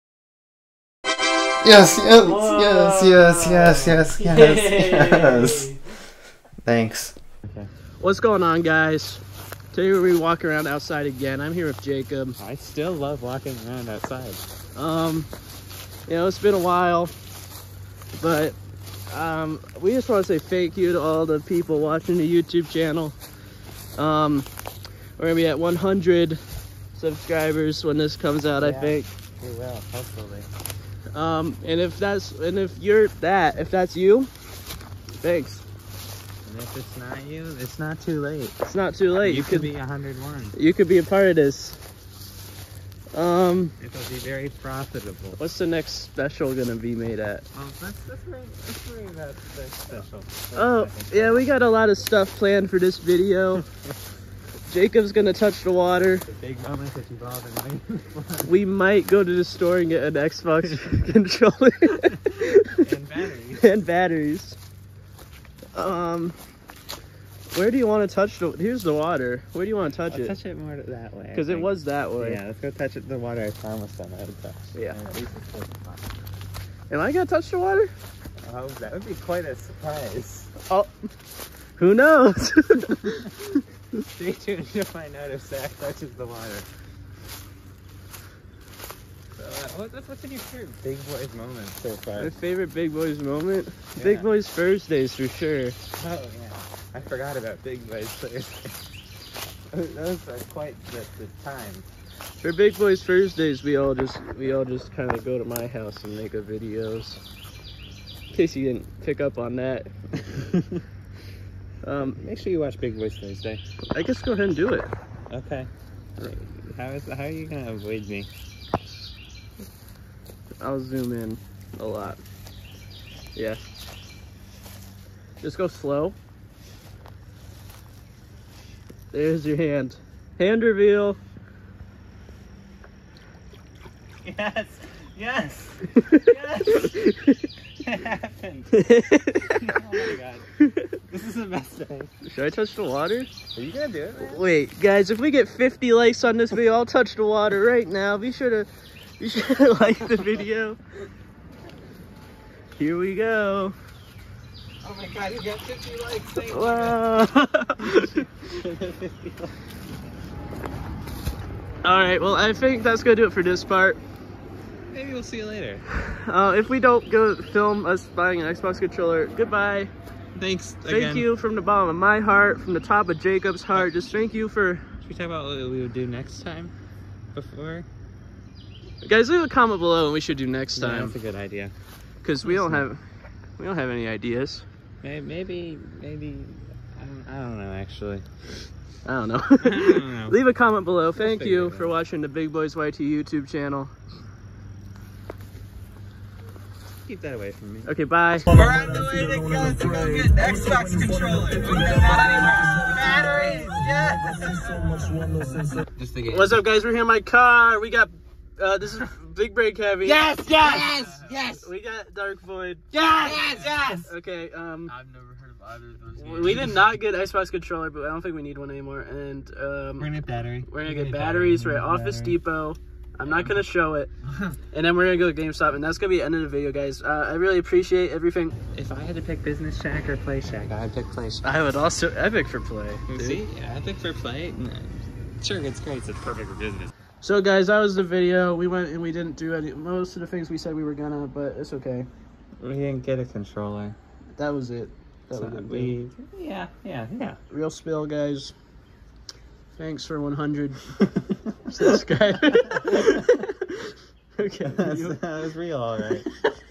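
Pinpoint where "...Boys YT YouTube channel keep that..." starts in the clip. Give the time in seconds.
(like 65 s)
192 s.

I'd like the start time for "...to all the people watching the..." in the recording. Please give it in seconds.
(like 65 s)
20 s.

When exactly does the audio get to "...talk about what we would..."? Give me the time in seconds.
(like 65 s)
175 s.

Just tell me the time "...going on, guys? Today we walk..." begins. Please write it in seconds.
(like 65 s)
8 s.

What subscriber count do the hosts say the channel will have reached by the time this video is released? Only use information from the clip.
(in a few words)
100.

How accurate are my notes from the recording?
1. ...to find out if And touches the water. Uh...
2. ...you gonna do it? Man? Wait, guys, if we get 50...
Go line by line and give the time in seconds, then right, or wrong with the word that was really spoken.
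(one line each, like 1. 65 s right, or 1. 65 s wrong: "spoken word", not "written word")
1. 84 s wrong: "Zach", not "And"
2. 143 s right.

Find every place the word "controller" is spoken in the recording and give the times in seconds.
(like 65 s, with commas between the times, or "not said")
61 s, 168 s, 200 s, 217 s, 243 s.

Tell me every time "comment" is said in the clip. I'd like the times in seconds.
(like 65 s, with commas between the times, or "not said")
179 s, 190 s.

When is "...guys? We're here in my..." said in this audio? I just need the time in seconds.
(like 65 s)
206 s.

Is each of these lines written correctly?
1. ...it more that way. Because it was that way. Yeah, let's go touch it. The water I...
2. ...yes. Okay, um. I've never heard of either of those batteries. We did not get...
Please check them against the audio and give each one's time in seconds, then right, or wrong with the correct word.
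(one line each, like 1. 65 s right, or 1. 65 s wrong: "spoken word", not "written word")
1. 70 s right
2. 213 s wrong: "games", not "batteries".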